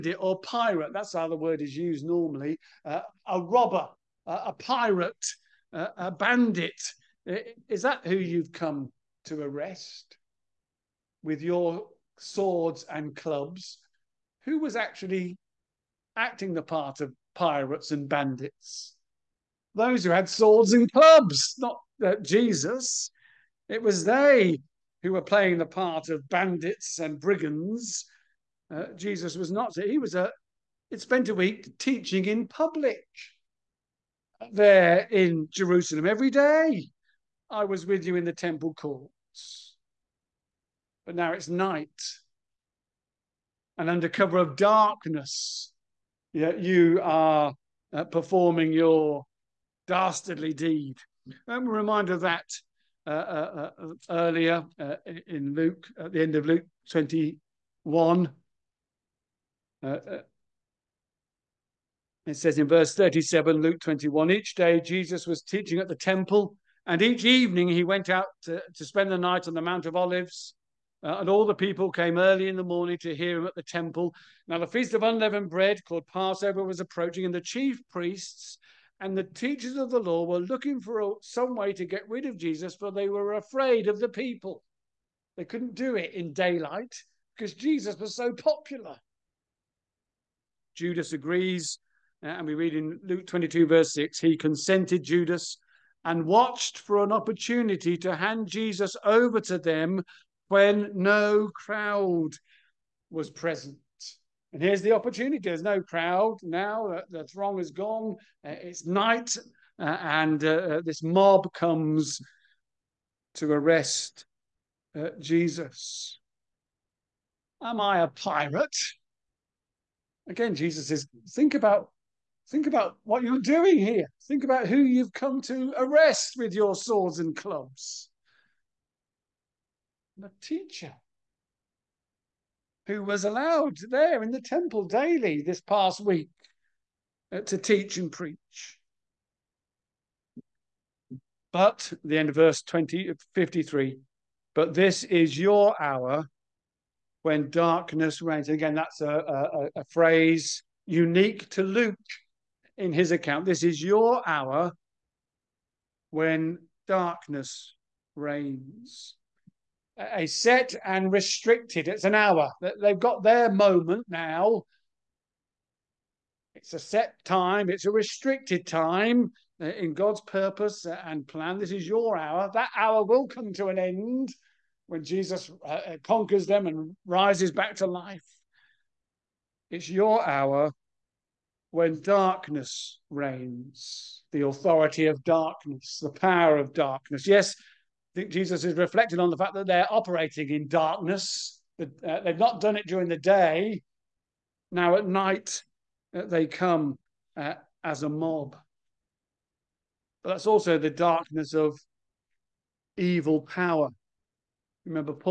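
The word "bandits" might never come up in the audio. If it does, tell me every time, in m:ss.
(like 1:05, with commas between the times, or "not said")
0:06, 0:18, 0:26.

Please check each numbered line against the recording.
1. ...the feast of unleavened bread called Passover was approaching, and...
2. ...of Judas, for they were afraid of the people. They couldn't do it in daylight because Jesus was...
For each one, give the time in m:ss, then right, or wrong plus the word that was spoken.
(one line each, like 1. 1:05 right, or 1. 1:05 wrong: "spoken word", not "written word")
1. 1:14 right
2. 1:22 wrong: "Jesus", not "Judas".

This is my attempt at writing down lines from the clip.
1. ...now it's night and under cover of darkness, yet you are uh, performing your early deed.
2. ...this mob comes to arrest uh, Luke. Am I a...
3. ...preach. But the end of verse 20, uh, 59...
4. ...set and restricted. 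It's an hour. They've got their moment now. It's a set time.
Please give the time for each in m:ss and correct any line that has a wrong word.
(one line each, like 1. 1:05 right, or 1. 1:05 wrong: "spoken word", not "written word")
1. 0:41 wrong: "dastardly", not "early"
2. 1:50 wrong: "Jesus", not "Luke"
3. 2:18 wrong: "53", not "59"
4. 2:40 right.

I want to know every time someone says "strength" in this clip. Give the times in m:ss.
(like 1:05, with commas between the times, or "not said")
not said.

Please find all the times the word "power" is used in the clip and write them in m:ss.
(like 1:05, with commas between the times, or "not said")
3:06, 3:23.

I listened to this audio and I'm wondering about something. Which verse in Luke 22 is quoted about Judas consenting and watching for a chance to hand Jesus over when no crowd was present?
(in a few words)
Verse 6.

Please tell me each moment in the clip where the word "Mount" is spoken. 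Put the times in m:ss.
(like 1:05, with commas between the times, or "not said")
1:09.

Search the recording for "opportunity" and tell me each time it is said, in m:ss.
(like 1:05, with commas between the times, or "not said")
1:37, 1:44.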